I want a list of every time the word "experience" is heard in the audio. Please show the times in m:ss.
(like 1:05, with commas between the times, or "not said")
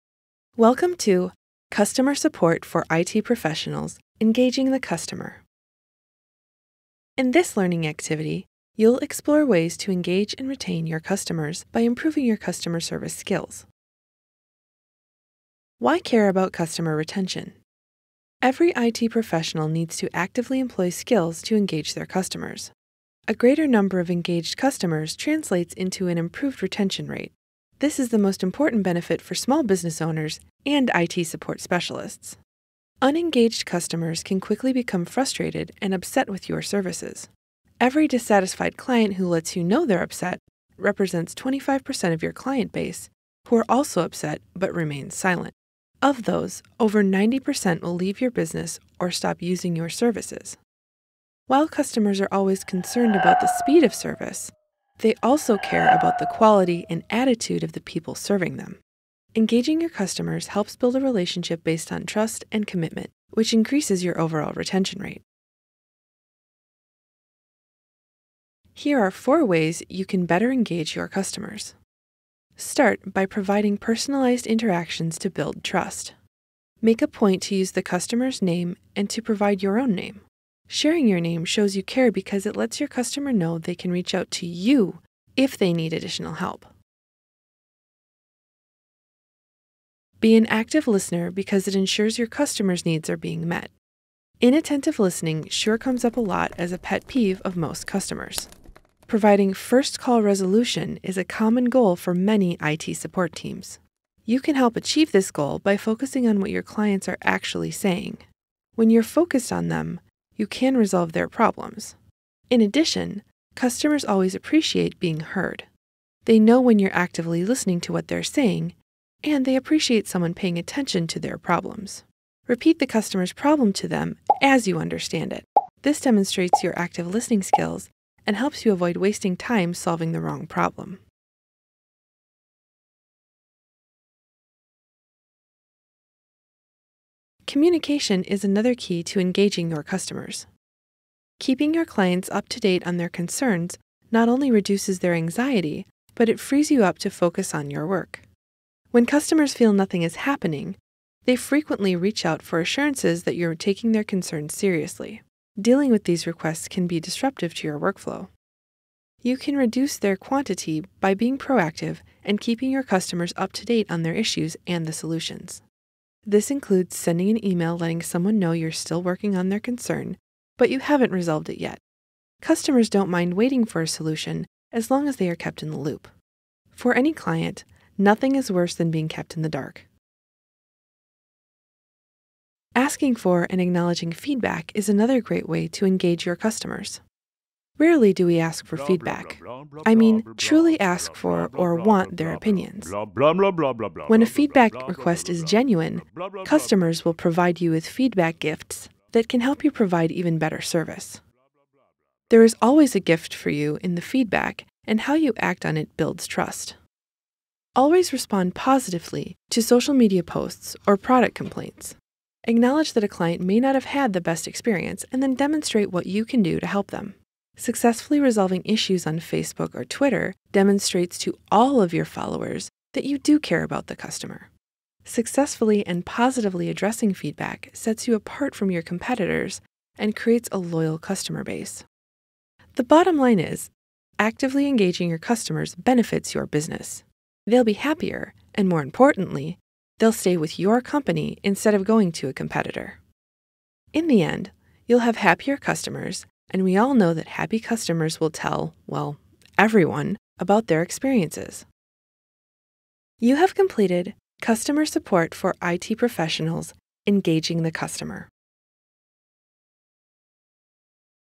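3:34, 4:10.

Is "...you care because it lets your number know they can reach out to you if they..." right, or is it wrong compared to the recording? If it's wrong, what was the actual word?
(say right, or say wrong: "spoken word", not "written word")
wrong: "customer", not "number".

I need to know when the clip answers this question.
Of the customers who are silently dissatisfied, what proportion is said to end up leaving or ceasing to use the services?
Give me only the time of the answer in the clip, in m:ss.
0:46.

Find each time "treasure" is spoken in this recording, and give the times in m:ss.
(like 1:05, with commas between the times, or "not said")
not said.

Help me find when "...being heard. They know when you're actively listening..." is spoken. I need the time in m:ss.
1:54.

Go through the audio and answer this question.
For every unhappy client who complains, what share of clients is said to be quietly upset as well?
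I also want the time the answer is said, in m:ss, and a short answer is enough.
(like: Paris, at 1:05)
25%, at 0:41.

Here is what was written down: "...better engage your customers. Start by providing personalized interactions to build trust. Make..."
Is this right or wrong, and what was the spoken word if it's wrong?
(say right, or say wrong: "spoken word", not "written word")
right.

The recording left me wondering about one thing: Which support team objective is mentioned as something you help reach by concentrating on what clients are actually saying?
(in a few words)
first call resolution.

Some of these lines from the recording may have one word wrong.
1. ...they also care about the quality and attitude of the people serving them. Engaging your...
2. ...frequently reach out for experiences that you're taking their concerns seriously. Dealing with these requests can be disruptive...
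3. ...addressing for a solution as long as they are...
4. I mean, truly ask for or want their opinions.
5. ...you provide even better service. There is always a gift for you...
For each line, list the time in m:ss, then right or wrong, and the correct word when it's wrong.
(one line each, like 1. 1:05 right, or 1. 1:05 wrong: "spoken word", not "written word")
1. 0:55 right
2. 2:31 wrong: "assurances", not "experiences"
3. 2:53 wrong: "waiting", not "addressing"
4. 3:09 right
5. 3:19 right.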